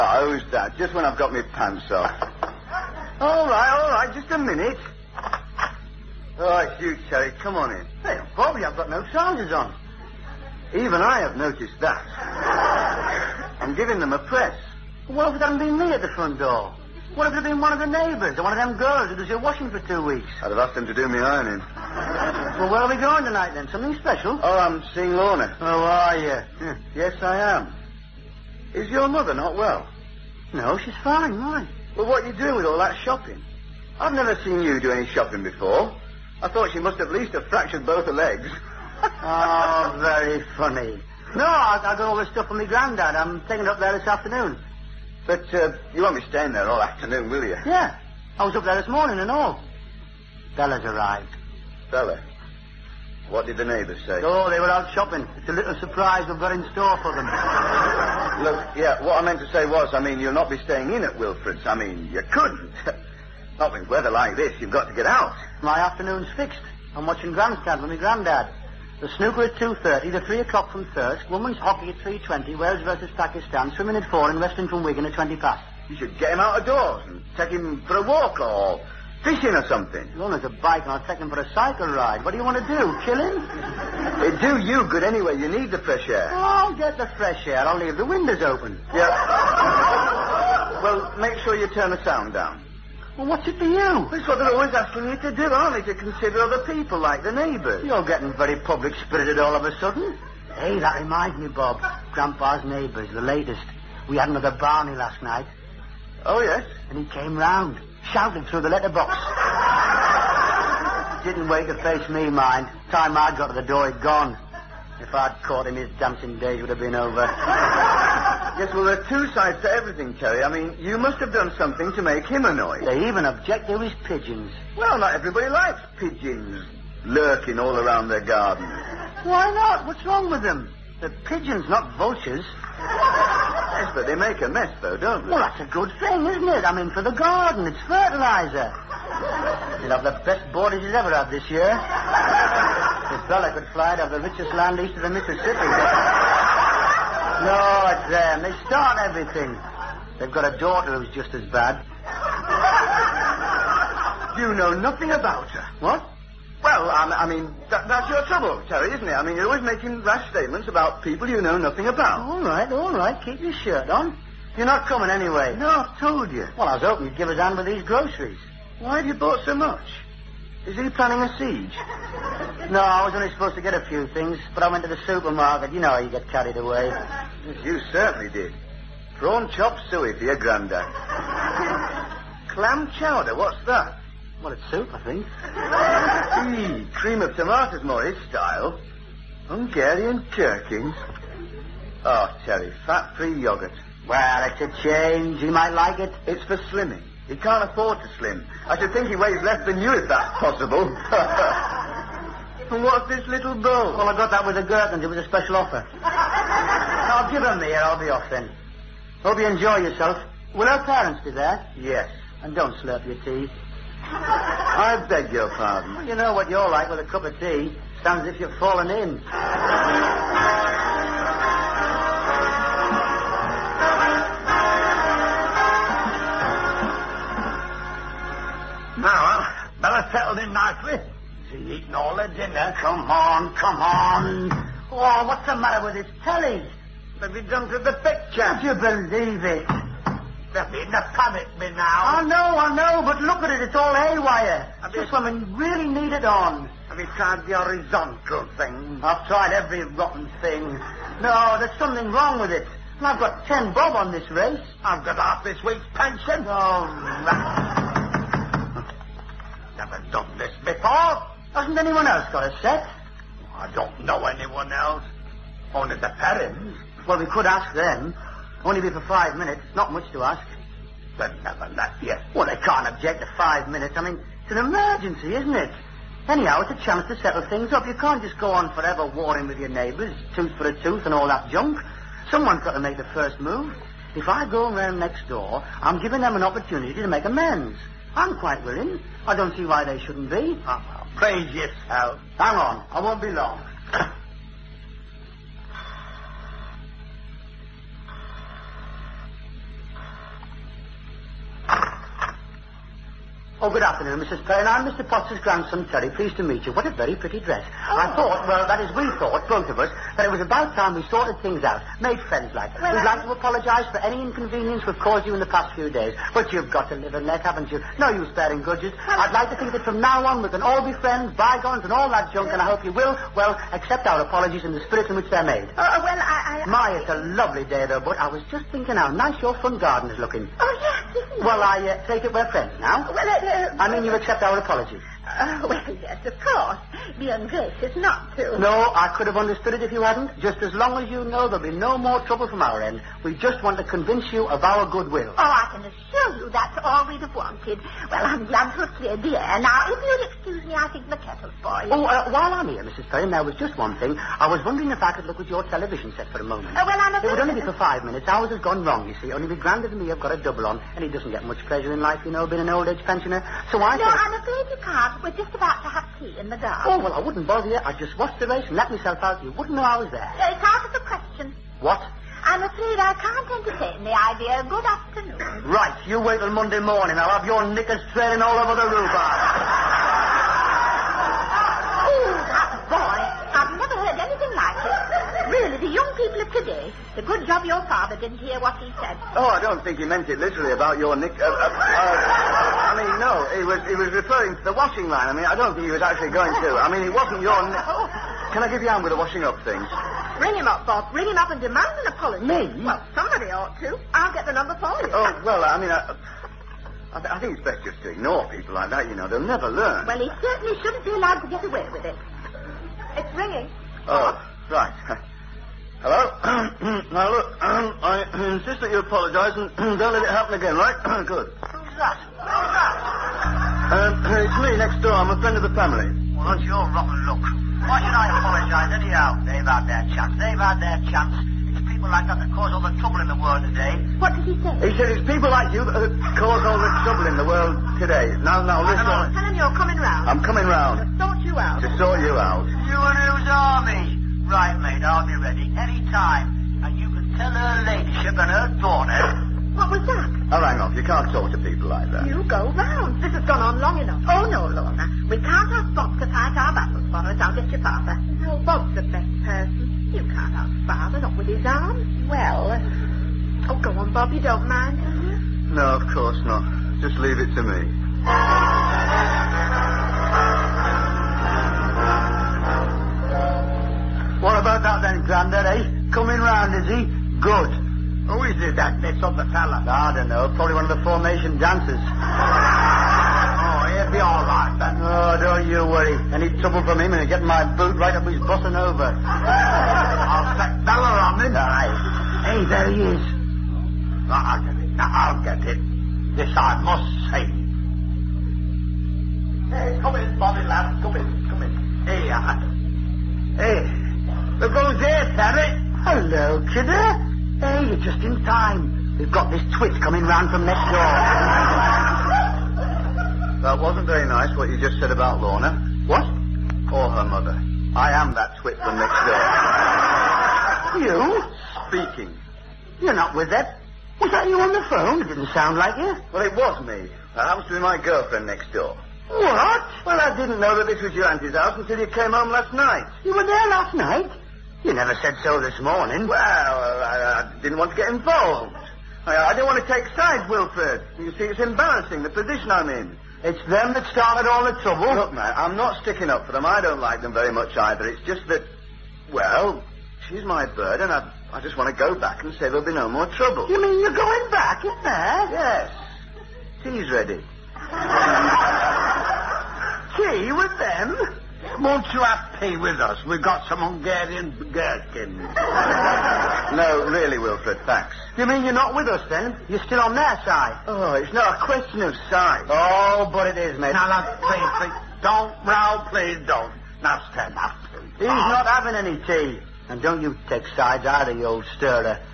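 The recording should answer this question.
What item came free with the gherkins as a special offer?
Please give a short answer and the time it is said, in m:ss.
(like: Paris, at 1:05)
little bowl, at 3:22.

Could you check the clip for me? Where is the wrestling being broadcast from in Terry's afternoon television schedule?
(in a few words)
Wigan.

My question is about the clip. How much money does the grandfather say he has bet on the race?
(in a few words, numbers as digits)
ten bob.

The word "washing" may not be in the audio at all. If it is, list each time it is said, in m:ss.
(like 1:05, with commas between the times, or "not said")
0:19, 6:34, 6:39.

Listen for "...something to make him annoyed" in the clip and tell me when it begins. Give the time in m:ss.
2:01.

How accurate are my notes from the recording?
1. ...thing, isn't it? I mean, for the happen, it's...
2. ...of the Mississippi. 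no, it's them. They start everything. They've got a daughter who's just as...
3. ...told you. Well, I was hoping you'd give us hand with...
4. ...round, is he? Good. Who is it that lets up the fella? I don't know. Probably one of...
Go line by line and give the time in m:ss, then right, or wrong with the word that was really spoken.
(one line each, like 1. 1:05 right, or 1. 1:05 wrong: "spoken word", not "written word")
1. 2:16 wrong: "garden", not "happen"
2. 2:24 right
3. 2:46 right
4. 7:56 right.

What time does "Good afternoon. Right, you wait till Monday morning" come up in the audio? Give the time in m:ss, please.
6:14.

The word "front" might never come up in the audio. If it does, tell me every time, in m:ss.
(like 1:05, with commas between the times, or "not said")
0:16, 5:29.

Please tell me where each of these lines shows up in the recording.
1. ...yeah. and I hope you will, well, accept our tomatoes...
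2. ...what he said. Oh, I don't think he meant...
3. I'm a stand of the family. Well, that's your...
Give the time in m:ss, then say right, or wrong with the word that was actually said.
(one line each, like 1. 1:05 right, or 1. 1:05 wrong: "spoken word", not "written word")
1. 5:22 wrong: "apologies", not "tomatoes"
2. 6:28 right
3. 7:05 wrong: "friend", not "stand".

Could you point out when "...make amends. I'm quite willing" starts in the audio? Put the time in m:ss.
4:47.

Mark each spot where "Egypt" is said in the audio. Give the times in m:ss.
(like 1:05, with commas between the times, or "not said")
not said.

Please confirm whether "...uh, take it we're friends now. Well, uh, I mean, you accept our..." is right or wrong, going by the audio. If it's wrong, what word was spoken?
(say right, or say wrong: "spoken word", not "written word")
right.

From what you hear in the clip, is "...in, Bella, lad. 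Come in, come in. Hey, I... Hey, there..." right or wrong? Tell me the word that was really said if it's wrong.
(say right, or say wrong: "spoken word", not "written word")
wrong: "Bobby", not "Bella".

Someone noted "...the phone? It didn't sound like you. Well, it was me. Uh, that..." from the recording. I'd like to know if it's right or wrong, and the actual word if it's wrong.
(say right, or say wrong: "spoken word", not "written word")
right.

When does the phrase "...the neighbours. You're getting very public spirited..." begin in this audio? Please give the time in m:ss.
1:37.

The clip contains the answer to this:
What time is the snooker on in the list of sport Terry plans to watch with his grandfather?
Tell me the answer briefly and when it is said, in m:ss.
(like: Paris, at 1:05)
2.30, at 1:09.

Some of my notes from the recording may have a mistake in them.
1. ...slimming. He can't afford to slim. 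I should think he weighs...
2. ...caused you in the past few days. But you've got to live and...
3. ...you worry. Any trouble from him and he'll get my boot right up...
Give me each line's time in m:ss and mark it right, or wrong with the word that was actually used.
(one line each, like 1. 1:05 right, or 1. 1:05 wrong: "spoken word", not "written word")
1. 3:16 right
2. 5:15 right
3. 8:05 right.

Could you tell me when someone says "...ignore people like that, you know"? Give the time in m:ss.
6:48.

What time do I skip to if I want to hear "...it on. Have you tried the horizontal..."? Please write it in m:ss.
4:06.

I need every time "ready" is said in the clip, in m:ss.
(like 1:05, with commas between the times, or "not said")
7:25, 9:17.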